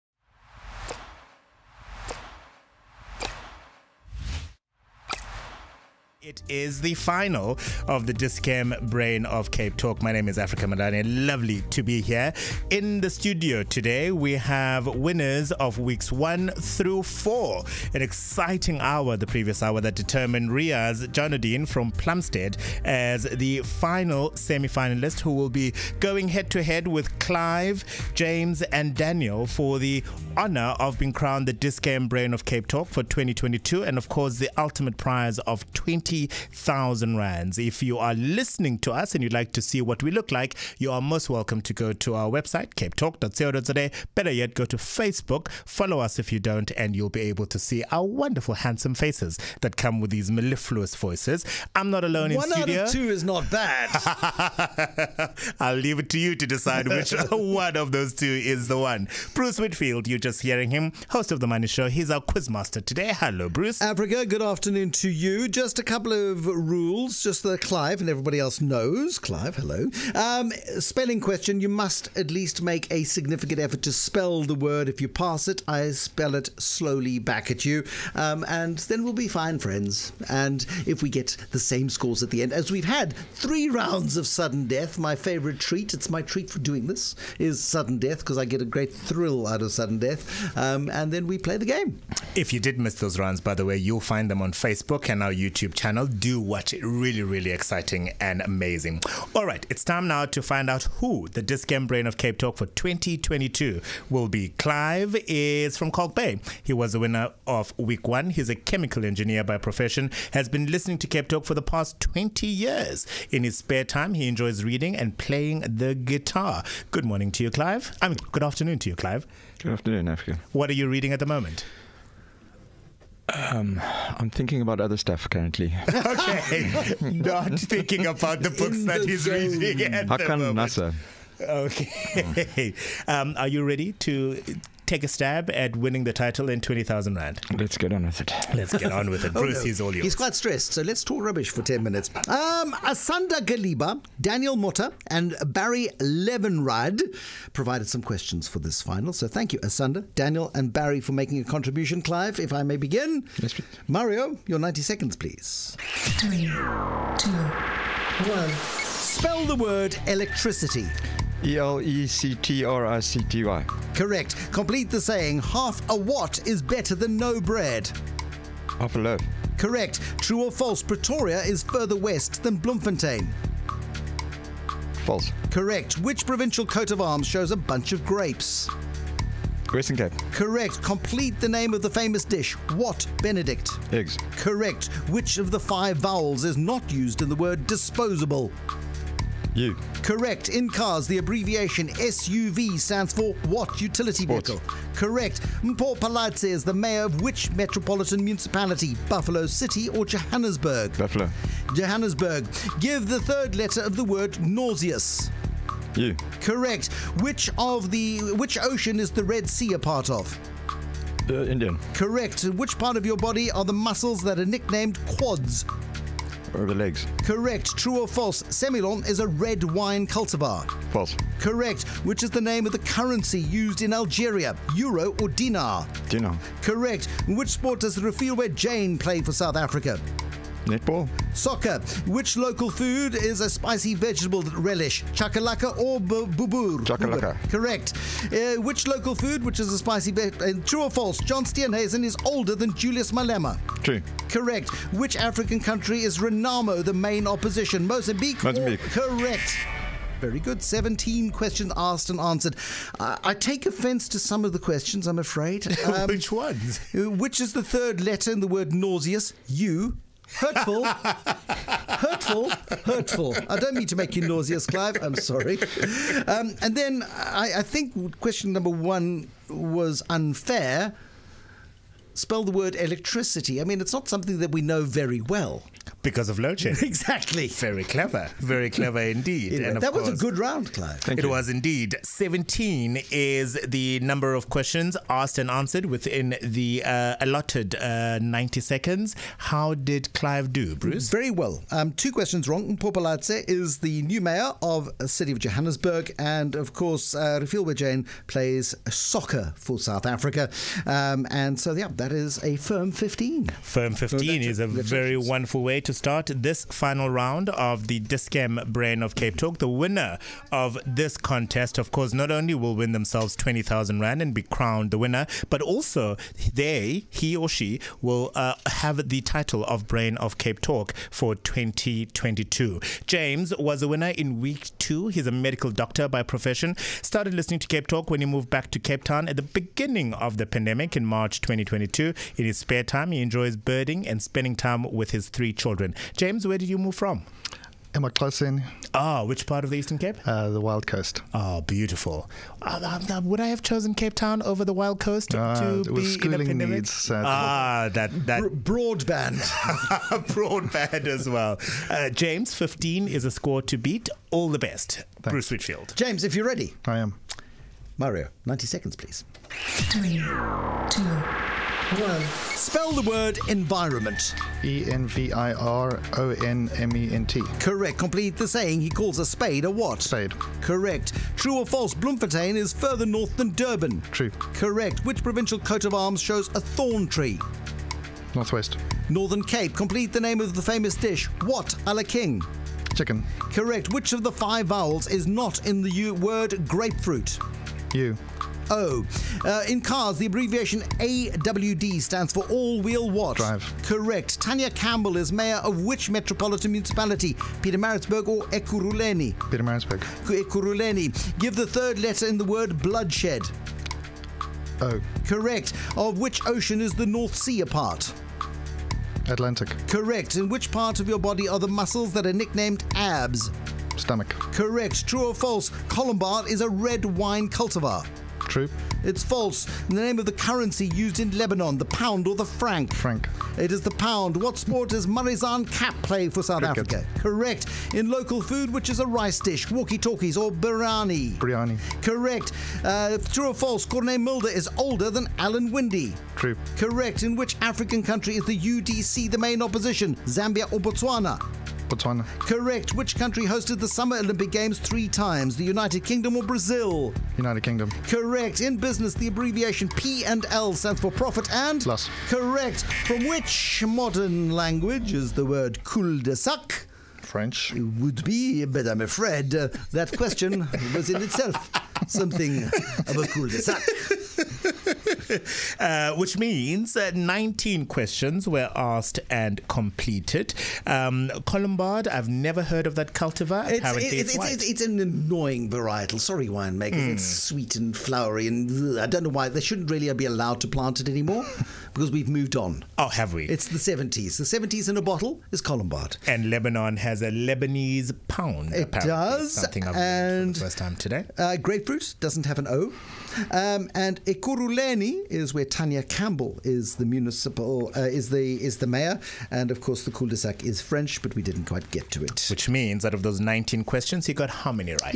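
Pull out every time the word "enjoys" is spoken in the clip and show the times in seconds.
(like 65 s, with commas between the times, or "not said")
114 s, 333 s.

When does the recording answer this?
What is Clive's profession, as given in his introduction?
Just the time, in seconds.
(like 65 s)
108 s.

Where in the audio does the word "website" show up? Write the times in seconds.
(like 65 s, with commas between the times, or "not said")
42 s.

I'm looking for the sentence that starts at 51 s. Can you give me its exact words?
I'm not alone One in studio.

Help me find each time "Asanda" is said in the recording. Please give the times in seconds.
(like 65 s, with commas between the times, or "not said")
142 s, 149 s.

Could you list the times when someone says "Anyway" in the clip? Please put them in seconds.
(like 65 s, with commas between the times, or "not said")
279 s.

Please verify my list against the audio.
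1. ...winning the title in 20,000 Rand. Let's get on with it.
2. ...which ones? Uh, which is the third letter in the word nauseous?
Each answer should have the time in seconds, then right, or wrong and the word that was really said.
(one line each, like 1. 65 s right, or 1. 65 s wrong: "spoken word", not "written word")
1. 135 s right
2. 256 s right.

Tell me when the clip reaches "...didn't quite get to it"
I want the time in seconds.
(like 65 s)
501 s.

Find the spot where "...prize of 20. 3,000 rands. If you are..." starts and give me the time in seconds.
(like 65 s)
34 s.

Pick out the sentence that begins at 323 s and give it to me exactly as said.
James was a winner in week two.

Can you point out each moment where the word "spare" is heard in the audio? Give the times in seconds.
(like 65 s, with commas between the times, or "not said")
113 s, 332 s.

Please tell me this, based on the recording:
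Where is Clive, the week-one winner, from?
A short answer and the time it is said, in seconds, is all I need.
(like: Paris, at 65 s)
Kalk Bay, at 105 s.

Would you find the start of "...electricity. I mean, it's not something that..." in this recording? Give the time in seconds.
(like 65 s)
272 s.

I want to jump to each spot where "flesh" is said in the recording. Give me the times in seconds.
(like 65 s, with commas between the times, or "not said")
not said.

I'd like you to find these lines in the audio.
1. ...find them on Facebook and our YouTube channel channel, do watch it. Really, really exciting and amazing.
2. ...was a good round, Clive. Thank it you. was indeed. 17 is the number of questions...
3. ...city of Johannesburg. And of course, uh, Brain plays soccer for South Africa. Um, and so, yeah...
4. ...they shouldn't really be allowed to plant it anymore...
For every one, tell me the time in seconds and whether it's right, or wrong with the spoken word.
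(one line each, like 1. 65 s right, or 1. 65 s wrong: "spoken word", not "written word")
1. 94 s right
2. 280 s right
3. 295 s wrong: "Jane", not "Brain"
4. 479 s right.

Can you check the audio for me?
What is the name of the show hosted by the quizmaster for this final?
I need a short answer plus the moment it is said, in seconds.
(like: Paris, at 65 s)
The Money Show, at 61 s.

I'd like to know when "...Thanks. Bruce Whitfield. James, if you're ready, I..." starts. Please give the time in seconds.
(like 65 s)
355 s.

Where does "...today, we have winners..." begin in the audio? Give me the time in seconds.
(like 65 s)
13 s.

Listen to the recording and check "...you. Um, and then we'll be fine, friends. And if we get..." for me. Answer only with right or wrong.
right.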